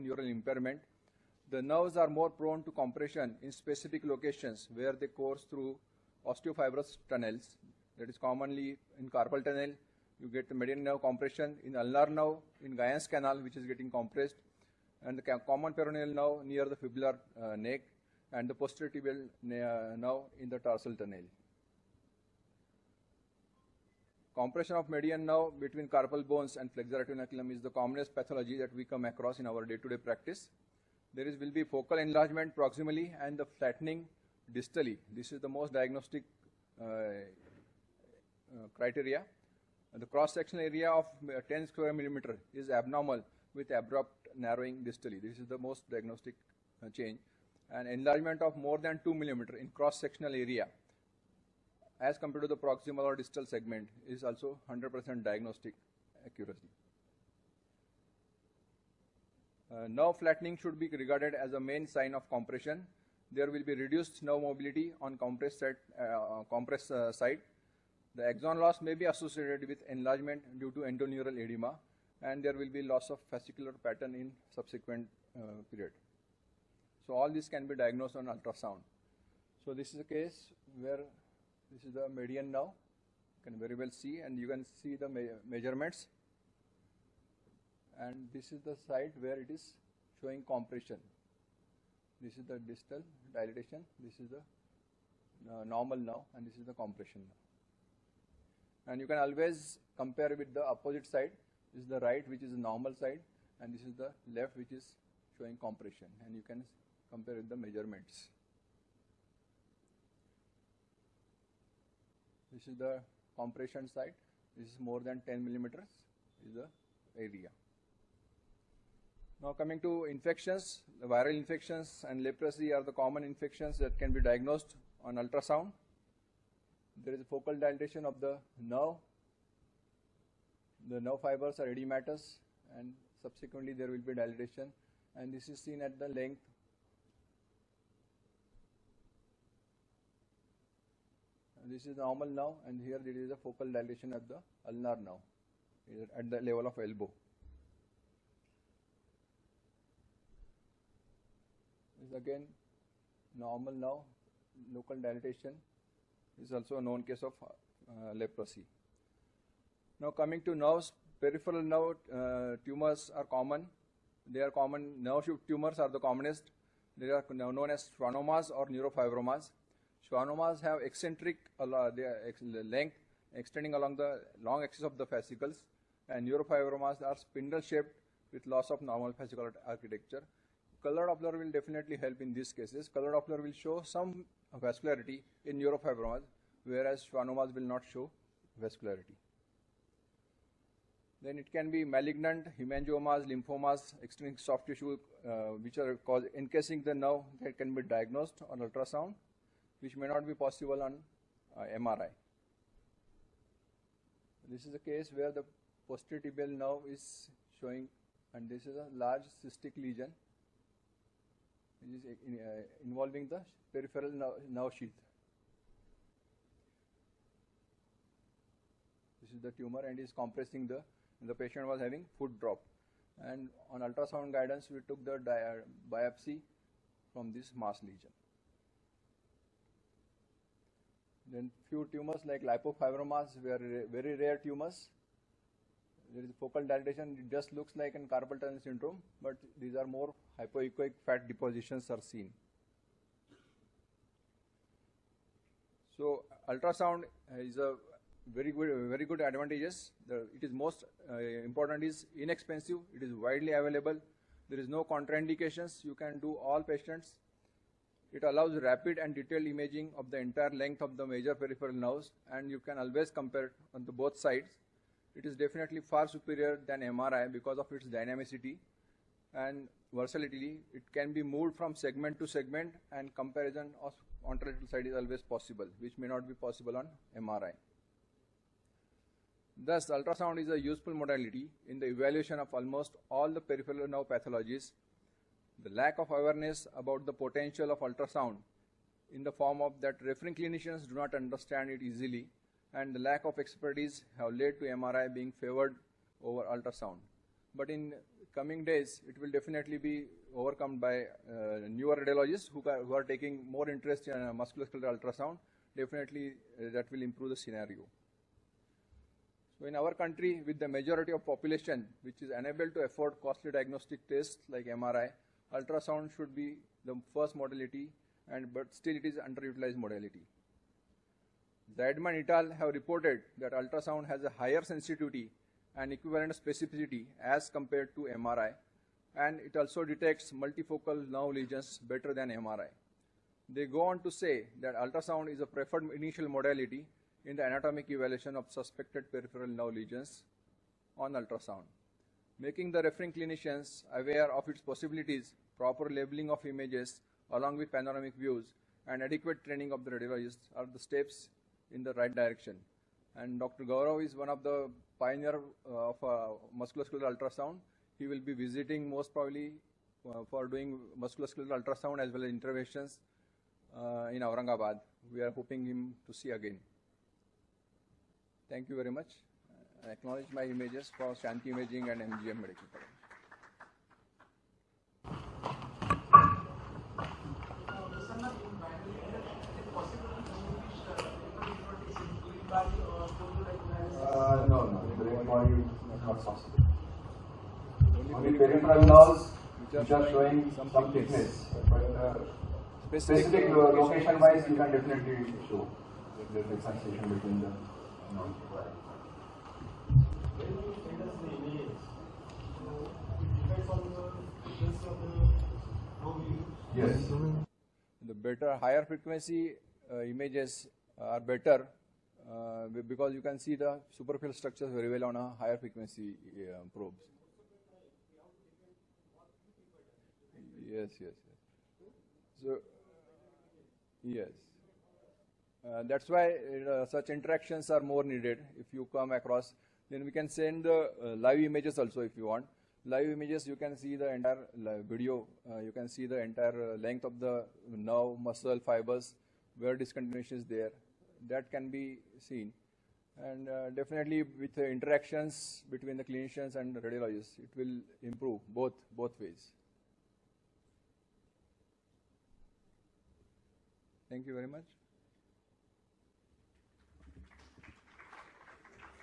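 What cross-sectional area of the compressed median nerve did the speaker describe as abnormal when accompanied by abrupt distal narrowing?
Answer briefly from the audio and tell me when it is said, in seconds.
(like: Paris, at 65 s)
10 square millimeters, at 41 s.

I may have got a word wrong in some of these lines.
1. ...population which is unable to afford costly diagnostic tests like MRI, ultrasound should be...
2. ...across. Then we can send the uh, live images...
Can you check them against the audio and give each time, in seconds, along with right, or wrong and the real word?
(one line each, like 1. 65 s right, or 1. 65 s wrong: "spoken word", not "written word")
1. 311 s right
2. 429 s right.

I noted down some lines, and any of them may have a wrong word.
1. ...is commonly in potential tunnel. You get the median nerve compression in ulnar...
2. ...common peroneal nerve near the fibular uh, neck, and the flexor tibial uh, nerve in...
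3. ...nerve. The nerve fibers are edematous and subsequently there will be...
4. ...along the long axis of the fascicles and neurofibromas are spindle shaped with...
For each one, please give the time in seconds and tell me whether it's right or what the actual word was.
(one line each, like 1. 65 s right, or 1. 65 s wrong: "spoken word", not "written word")
1. 8 s wrong: "carpal", not "potential"
2. 15 s wrong: "posterior", not "flexor"
3. 128 s right
4. 173 s right.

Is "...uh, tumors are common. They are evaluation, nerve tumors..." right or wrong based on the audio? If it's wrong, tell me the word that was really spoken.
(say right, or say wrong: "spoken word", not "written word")
wrong: "common", not "evaluation".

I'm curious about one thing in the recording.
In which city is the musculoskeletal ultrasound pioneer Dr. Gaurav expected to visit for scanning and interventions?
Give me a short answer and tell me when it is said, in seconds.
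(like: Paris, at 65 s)
Aurangabad, at 364 s.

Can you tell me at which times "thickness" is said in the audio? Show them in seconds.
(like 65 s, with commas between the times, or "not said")
390 s.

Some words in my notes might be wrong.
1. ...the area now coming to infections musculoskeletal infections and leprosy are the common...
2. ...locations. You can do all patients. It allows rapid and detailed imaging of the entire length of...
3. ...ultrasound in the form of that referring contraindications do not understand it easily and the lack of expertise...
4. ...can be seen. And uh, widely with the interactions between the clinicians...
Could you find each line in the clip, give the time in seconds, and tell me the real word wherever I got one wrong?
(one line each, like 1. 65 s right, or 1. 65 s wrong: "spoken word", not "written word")
1. 116 s wrong: "viral", not "musculoskeletal"
2. 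254 s wrong: "contraindications", not "locations"
3. 287 s wrong: "clinicians", not "contraindications"
4. 441 s wrong: "definitely", not "widely".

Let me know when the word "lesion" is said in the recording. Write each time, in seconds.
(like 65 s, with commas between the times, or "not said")
209 s, 227 s, 331 s, 339 s.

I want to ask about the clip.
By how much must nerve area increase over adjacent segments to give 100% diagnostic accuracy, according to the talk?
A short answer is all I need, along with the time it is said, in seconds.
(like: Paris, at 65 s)
2 millimeters, at 49 s.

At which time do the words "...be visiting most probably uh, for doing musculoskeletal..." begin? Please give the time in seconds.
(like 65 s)
358 s.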